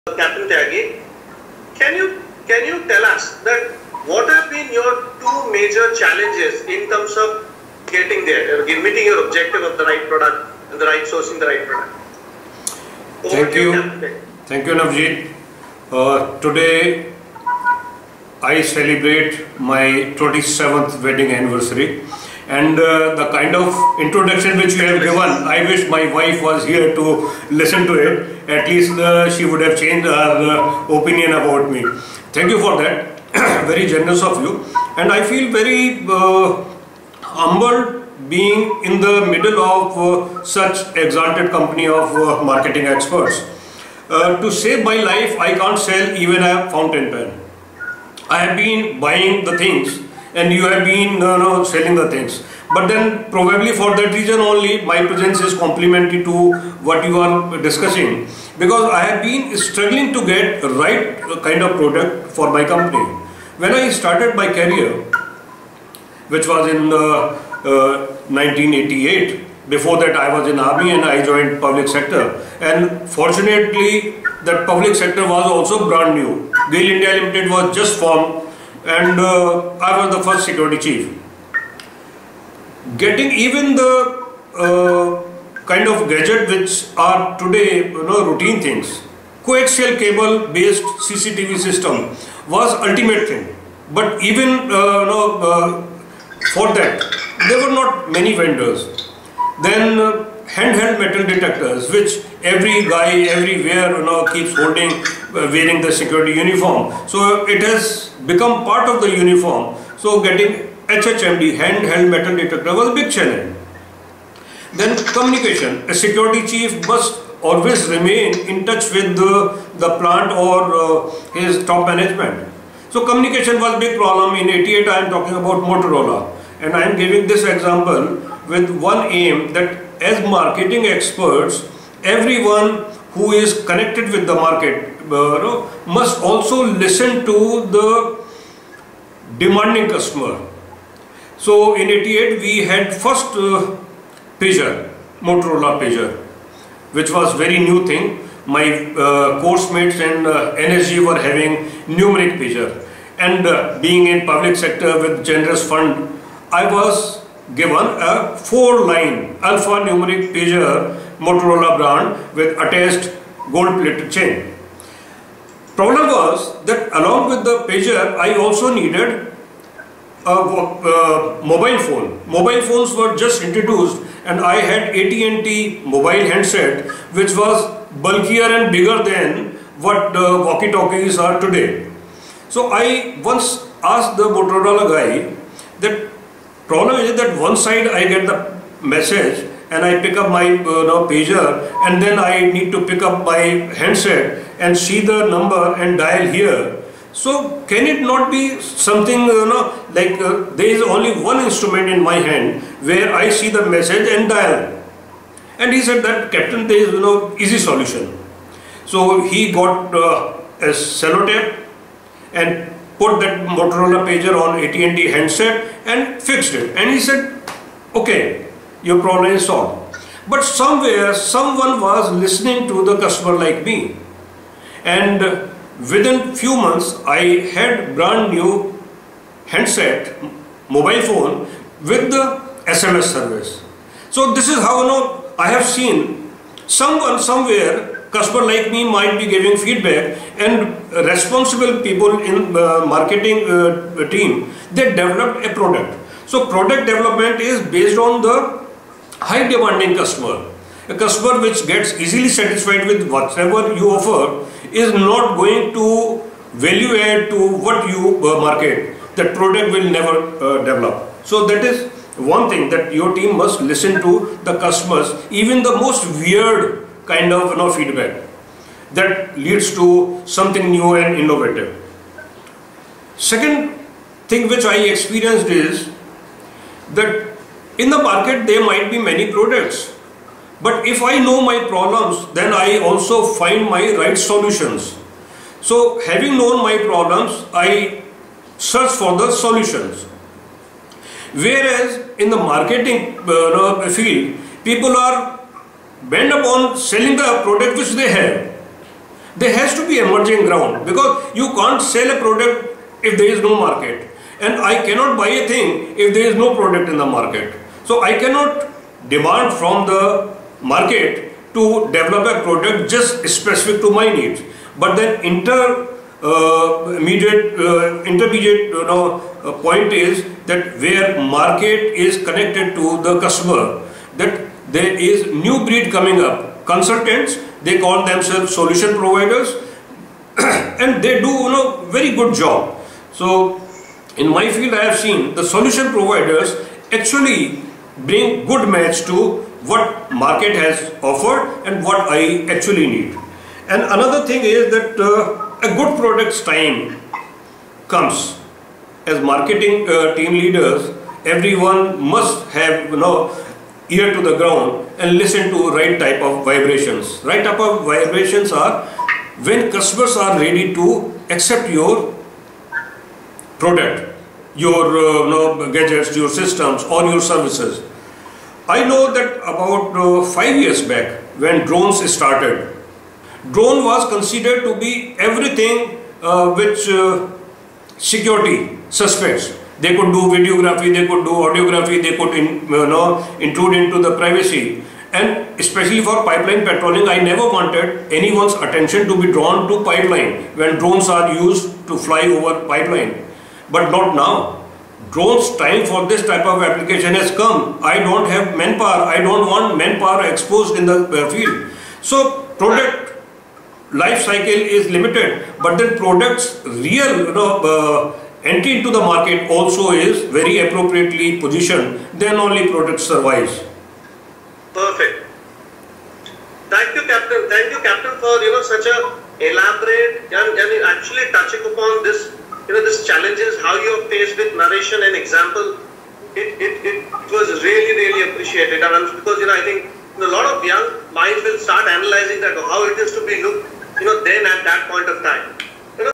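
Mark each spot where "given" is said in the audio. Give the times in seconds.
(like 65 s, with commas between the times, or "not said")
24 s, 157 s.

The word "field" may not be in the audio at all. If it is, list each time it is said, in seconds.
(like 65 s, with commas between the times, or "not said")
293 s, 334 s, 401 s.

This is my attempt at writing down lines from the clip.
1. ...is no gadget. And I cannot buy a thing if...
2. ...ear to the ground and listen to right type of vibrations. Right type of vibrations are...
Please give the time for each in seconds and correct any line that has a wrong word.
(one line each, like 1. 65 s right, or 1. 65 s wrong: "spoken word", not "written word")
1. 303 s wrong: "market", not "gadget"
2. 353 s right.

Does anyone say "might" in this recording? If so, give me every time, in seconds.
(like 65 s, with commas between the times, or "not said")
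238 s, 278 s.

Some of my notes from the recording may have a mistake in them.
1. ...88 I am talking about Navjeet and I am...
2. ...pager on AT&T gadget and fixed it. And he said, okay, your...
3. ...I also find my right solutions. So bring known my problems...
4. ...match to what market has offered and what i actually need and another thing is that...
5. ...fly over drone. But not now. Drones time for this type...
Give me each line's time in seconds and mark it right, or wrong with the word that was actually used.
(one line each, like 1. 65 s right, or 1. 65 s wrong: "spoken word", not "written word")
1. 124 s wrong: "Motorola", not "Navjeet"
2. 214 s wrong: "handset", not "gadget"
3. 282 s wrong: "having", not "bring"
4. 338 s right
5. 391 s wrong: "pipeline", not "drone".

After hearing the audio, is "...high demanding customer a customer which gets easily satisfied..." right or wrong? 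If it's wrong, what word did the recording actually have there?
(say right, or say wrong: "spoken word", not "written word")
right.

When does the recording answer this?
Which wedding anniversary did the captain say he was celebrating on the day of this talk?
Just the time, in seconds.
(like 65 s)
20 s.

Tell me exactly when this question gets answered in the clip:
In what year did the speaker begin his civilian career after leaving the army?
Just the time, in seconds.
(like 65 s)
68 s.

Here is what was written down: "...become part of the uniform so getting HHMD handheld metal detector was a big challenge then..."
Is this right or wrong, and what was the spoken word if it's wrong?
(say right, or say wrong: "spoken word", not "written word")
right.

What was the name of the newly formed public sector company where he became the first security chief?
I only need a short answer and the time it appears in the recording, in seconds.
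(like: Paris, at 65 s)
GAIL India Limited, at 76 s.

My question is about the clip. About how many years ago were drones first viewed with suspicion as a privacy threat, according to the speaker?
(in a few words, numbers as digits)
5 years.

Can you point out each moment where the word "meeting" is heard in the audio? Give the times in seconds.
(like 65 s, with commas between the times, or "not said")
8 s.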